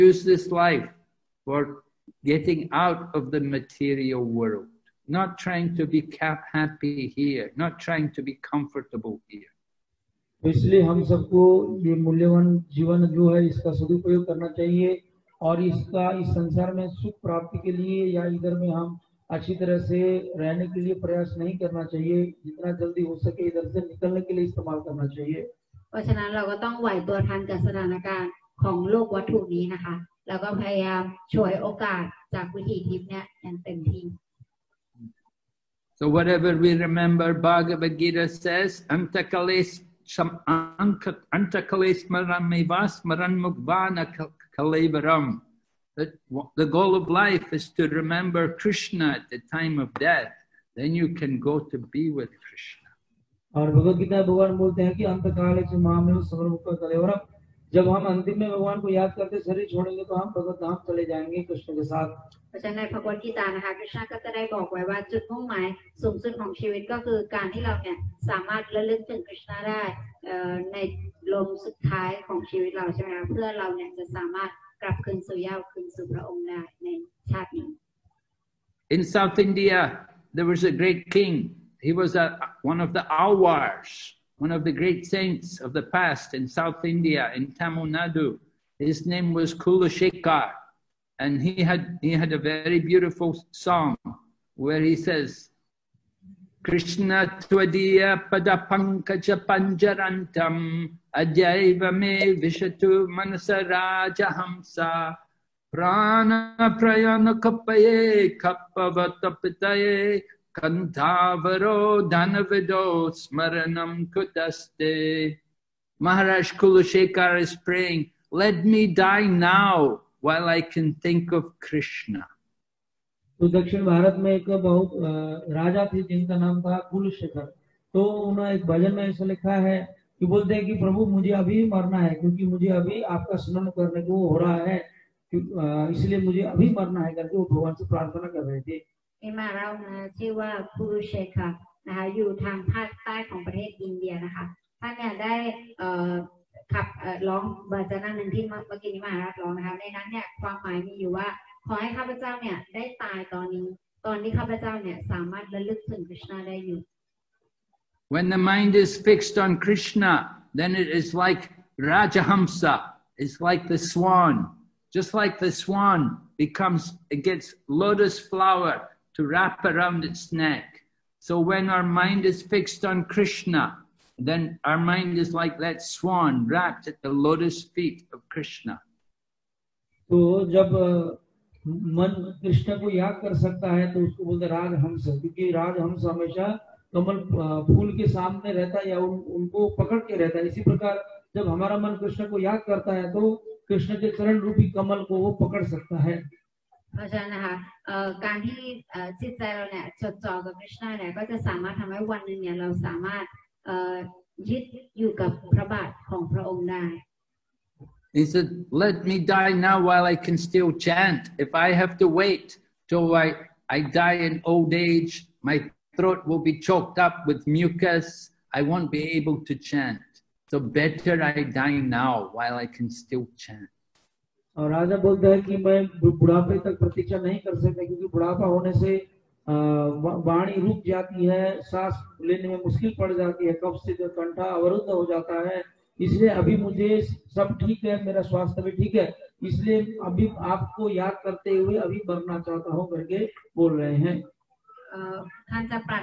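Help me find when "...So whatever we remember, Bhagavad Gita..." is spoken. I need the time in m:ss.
0:35.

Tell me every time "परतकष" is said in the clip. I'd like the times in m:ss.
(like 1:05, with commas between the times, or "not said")
3:46.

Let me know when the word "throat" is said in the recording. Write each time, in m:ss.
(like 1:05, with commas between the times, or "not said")
3:35.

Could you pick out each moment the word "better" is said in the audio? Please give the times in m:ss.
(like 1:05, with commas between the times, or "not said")
3:40.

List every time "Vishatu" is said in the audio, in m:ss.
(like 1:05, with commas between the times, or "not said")
1:42.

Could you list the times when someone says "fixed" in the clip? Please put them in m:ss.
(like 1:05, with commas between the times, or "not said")
2:39, 2:52.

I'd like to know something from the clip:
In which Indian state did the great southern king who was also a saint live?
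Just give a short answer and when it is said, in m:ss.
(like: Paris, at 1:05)
Tamil Nadu, at 1:27.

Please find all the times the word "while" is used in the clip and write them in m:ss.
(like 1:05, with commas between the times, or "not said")
2:00, 3:29, 3:42.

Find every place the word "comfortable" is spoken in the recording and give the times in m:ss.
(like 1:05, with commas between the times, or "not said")
0:08.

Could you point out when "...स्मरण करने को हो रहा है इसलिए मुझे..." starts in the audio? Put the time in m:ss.
2:13.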